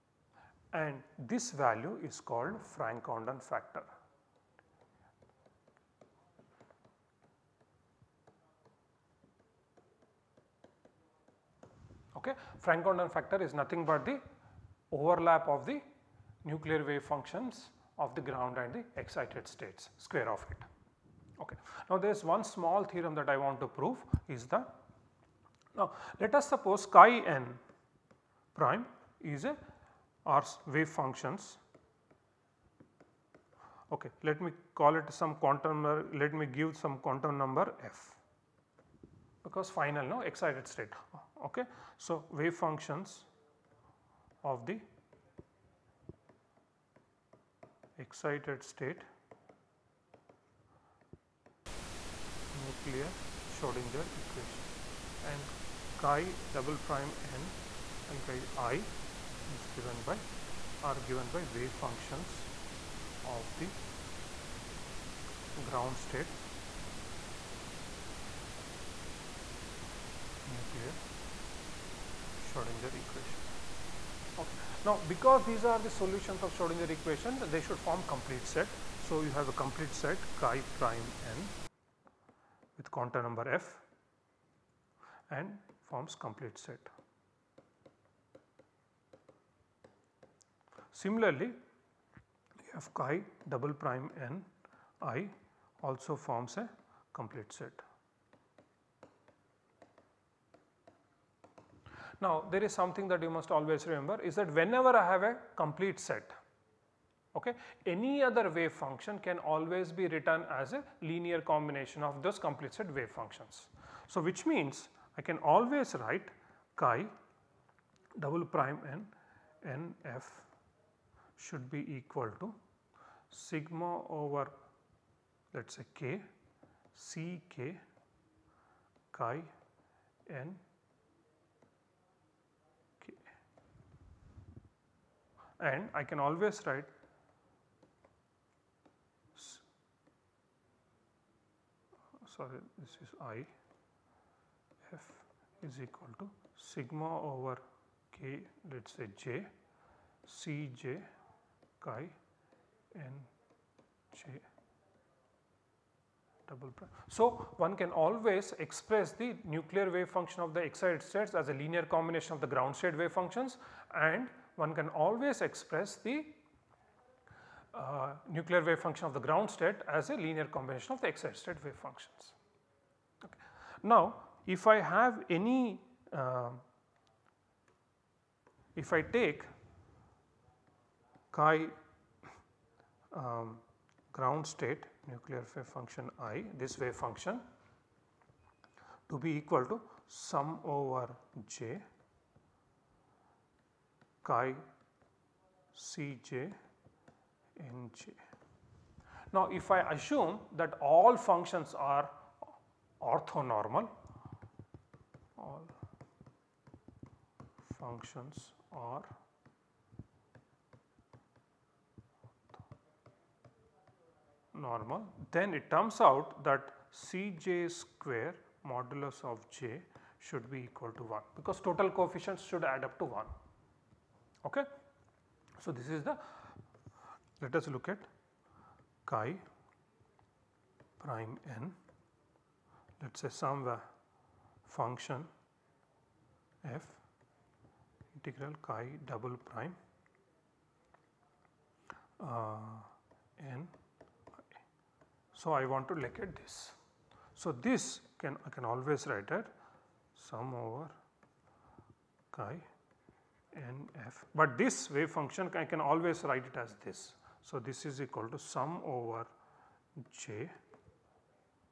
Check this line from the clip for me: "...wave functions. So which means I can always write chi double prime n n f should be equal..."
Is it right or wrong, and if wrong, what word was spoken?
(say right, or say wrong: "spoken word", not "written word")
right.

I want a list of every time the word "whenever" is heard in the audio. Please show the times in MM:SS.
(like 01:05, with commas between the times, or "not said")
01:44.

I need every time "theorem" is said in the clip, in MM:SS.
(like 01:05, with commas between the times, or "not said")
00:22.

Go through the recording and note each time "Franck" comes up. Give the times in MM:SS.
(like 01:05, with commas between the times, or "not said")
00:02, 00:12.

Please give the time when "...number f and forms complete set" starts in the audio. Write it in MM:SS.
01:23.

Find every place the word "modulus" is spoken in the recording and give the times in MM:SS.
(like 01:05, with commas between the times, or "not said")
03:38.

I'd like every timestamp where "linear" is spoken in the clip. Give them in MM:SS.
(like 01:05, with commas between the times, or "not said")
01:51, 02:41, 02:50.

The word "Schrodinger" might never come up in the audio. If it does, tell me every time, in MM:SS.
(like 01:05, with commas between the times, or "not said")
00:53, 01:12, 01:16.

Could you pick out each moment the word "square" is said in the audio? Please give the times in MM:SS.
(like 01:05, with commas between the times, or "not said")
00:19, 03:37.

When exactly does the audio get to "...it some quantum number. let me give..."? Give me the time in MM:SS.
00:34.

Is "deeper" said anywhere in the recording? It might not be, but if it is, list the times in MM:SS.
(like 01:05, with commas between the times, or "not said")
not said.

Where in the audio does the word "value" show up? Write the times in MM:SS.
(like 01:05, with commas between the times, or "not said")
00:01.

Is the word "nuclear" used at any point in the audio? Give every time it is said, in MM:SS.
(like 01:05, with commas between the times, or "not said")
00:16, 00:52, 01:10, 02:39, 02:48, 03:05.